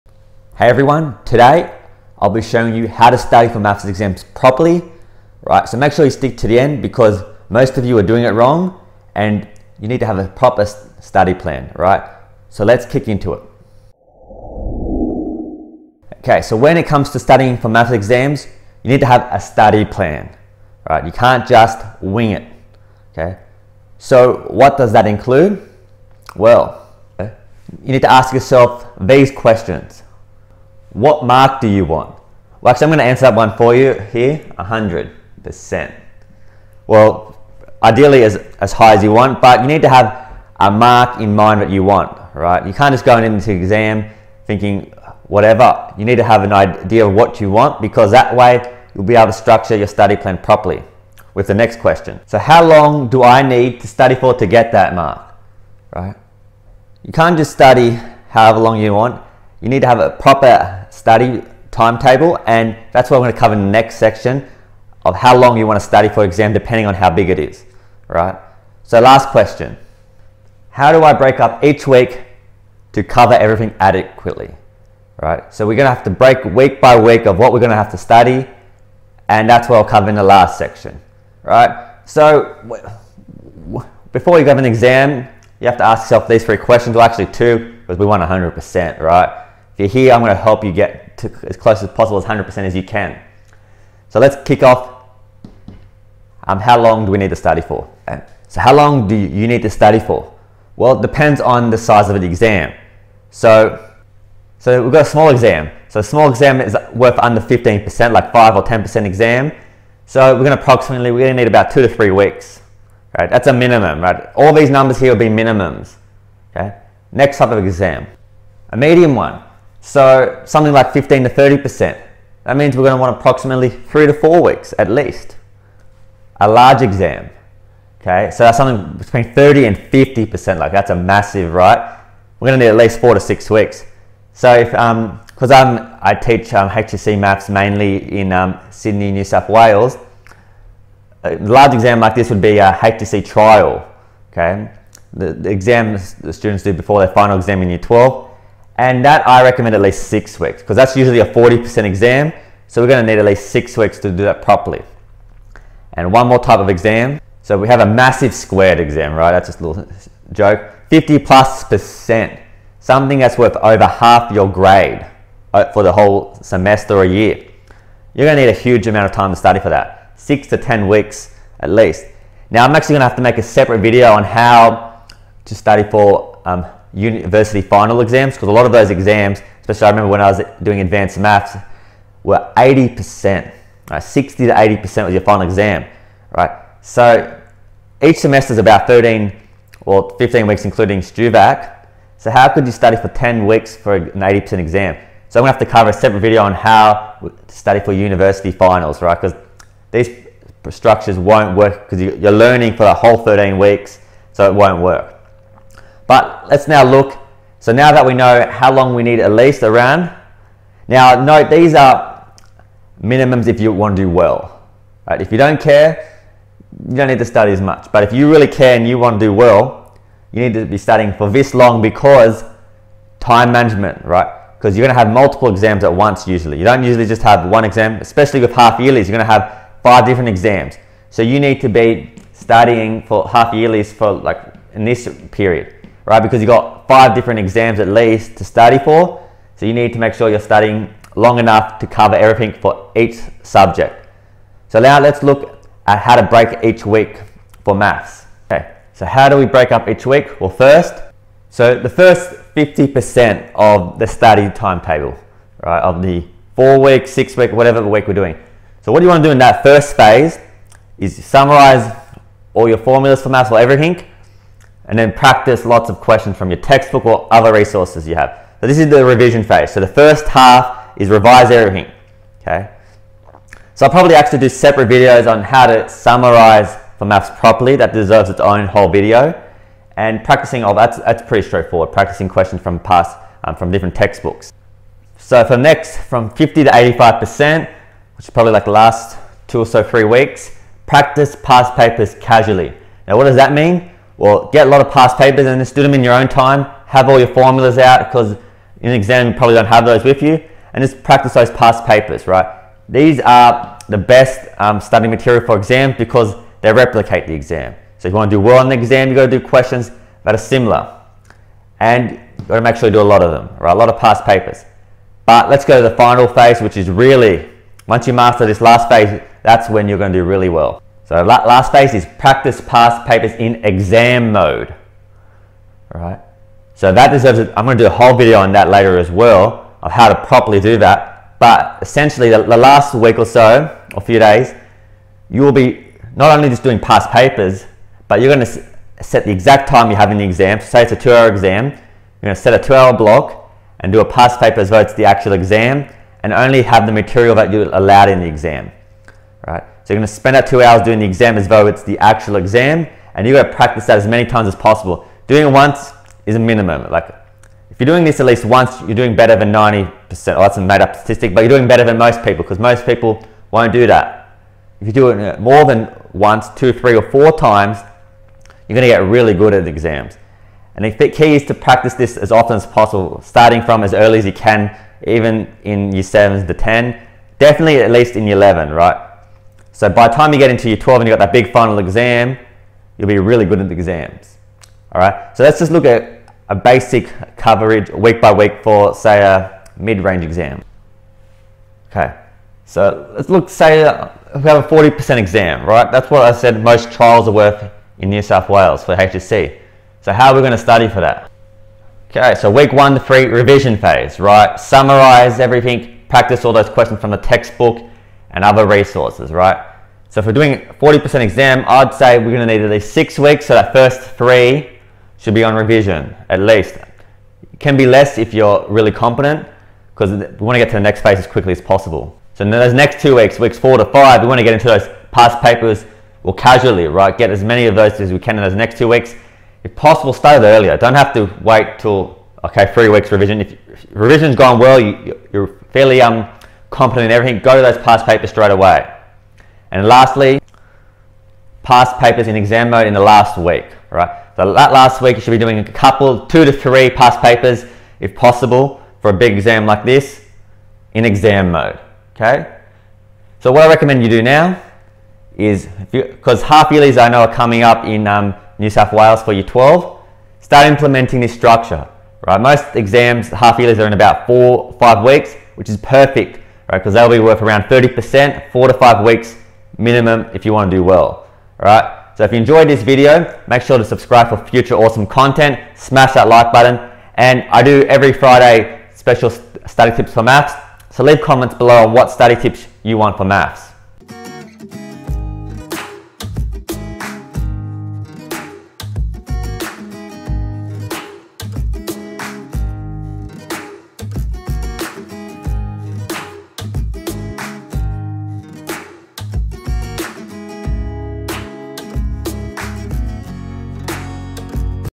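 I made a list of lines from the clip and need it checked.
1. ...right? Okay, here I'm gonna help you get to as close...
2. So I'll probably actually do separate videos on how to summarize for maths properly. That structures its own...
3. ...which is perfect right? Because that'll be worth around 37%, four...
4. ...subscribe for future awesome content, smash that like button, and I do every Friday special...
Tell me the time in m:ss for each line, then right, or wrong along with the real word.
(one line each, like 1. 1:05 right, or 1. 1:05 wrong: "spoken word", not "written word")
1. 1:29 right
2. 4:33 wrong: "deserves", not "structures"
3. 7:45 wrong: "30", not "37"
4. 7:53 right.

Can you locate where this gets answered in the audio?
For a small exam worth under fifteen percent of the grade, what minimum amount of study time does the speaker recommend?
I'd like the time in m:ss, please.
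1:51.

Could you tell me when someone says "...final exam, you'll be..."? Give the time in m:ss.
6:21.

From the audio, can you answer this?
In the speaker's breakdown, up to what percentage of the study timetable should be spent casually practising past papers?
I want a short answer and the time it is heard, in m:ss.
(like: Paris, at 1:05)
85%, at 4:46.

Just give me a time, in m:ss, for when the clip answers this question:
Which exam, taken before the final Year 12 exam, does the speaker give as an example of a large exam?
2:22.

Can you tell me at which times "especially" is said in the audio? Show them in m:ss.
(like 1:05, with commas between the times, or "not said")
2:59, 3:48.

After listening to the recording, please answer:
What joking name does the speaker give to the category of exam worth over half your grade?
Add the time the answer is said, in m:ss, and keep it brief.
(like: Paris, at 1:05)
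massive squared, at 2:37.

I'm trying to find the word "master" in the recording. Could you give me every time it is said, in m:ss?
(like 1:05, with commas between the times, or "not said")
5:18.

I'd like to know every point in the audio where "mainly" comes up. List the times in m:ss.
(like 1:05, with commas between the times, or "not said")
2:17.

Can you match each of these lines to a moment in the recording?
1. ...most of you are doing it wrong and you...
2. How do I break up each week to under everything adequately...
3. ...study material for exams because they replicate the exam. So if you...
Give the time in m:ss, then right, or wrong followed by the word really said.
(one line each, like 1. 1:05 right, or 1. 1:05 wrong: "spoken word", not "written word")
1. 0:07 right
2. 1:10 wrong: "cover", not "under"
3. 5:04 right.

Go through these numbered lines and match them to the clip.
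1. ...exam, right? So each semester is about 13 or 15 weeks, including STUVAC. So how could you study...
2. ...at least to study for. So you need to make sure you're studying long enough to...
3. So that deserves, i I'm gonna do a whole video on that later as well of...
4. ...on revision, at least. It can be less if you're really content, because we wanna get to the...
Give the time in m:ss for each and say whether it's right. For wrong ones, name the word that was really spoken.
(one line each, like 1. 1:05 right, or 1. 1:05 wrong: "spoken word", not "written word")
1. 3:05 right
2. 3:57 right
3. 5:26 right
4. 6:55 wrong: "competent", not "content".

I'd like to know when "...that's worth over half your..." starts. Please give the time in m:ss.
2:43.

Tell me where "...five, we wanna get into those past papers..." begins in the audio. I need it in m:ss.
7:03.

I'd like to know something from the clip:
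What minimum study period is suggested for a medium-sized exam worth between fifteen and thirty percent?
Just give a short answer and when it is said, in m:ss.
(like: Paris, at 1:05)
3 to 4 weeks, at 2:03.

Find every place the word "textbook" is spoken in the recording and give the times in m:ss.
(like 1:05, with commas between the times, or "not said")
4:26, 4:43, 6:47.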